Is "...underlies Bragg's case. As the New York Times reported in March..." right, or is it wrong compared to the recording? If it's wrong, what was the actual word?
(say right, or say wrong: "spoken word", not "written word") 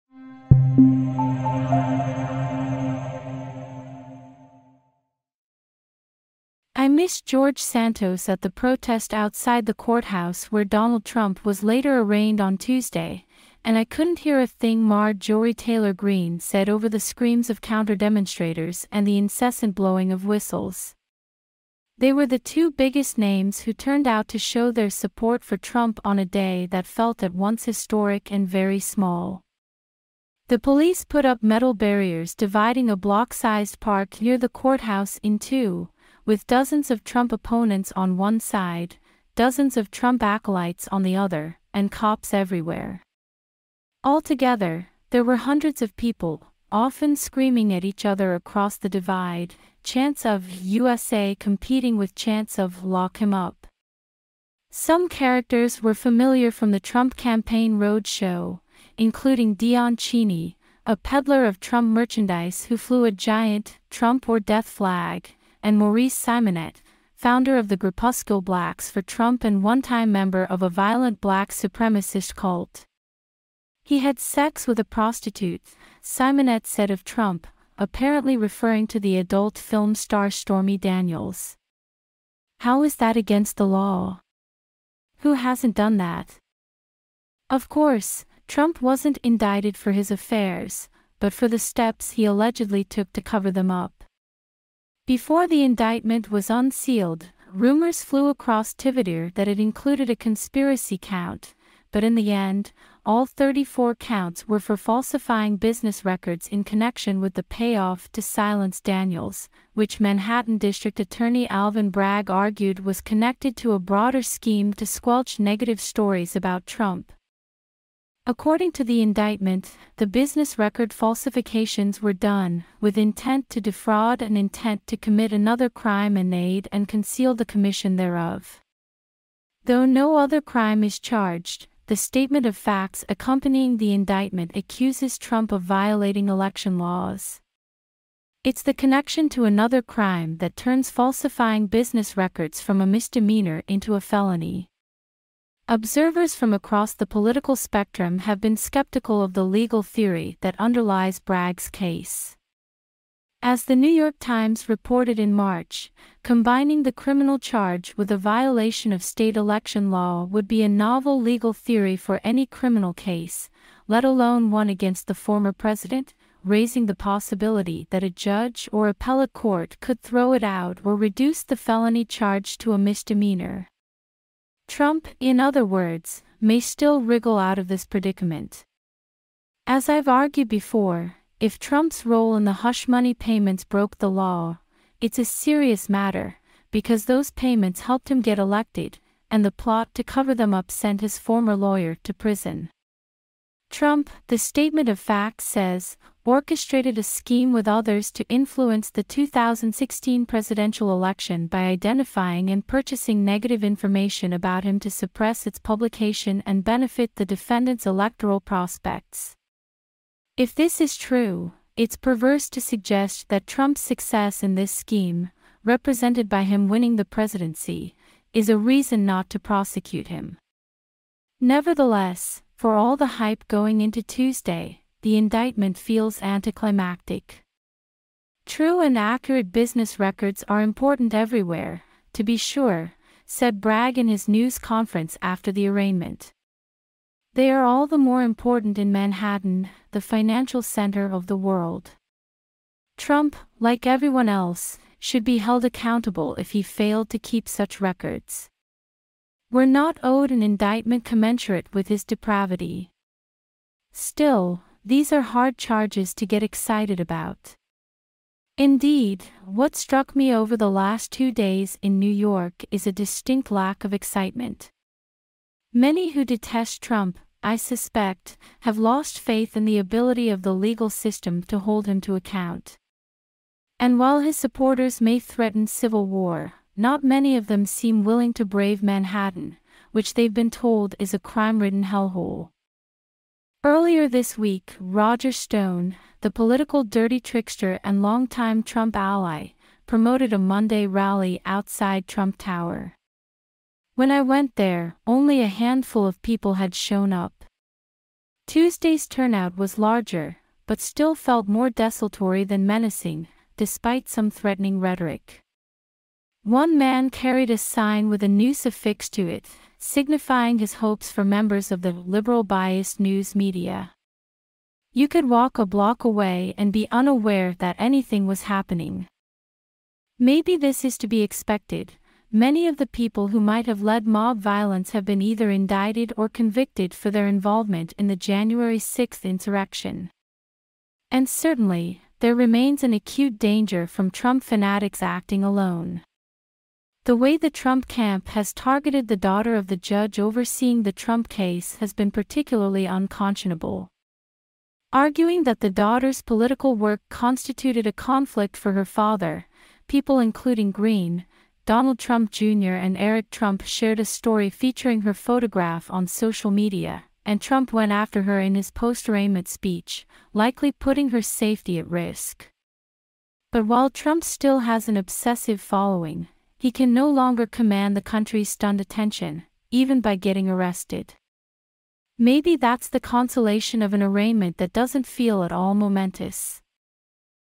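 right.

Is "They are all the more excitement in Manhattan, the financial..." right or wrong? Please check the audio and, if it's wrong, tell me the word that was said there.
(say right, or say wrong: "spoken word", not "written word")
wrong: "important", not "excitement".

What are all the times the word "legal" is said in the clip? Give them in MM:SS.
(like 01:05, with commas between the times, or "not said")
02:29, 02:41, 04:30.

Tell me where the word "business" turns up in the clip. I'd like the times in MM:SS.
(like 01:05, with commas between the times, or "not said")
01:45, 02:00, 02:21, 03:49.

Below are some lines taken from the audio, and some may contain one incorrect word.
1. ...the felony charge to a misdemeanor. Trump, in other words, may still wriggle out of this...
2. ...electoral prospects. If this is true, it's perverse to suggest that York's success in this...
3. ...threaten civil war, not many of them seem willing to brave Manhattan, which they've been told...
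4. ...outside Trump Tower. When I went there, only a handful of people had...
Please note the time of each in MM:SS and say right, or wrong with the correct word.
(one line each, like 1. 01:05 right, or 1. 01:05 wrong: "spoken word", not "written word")
1. 02:51 right
2. 03:27 wrong: "Trump", not "York"
3. 04:35 right
4. 04:51 right.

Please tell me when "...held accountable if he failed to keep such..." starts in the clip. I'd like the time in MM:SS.
04:05.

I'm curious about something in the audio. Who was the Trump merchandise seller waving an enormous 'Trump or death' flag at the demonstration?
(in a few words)
Dion Cheney.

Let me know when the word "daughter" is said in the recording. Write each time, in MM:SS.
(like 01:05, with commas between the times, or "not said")
05:39, 05:45.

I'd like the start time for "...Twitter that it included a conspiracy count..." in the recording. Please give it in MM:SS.
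01:38.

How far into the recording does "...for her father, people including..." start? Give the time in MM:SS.
05:48.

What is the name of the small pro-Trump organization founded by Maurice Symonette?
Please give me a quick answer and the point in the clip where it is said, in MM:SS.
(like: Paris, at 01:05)
Blacks for Trump, at 01:08.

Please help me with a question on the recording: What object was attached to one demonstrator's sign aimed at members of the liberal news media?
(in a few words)
a noose.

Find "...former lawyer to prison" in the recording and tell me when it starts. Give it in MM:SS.
03:11.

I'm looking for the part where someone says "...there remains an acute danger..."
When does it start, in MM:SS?
05:32.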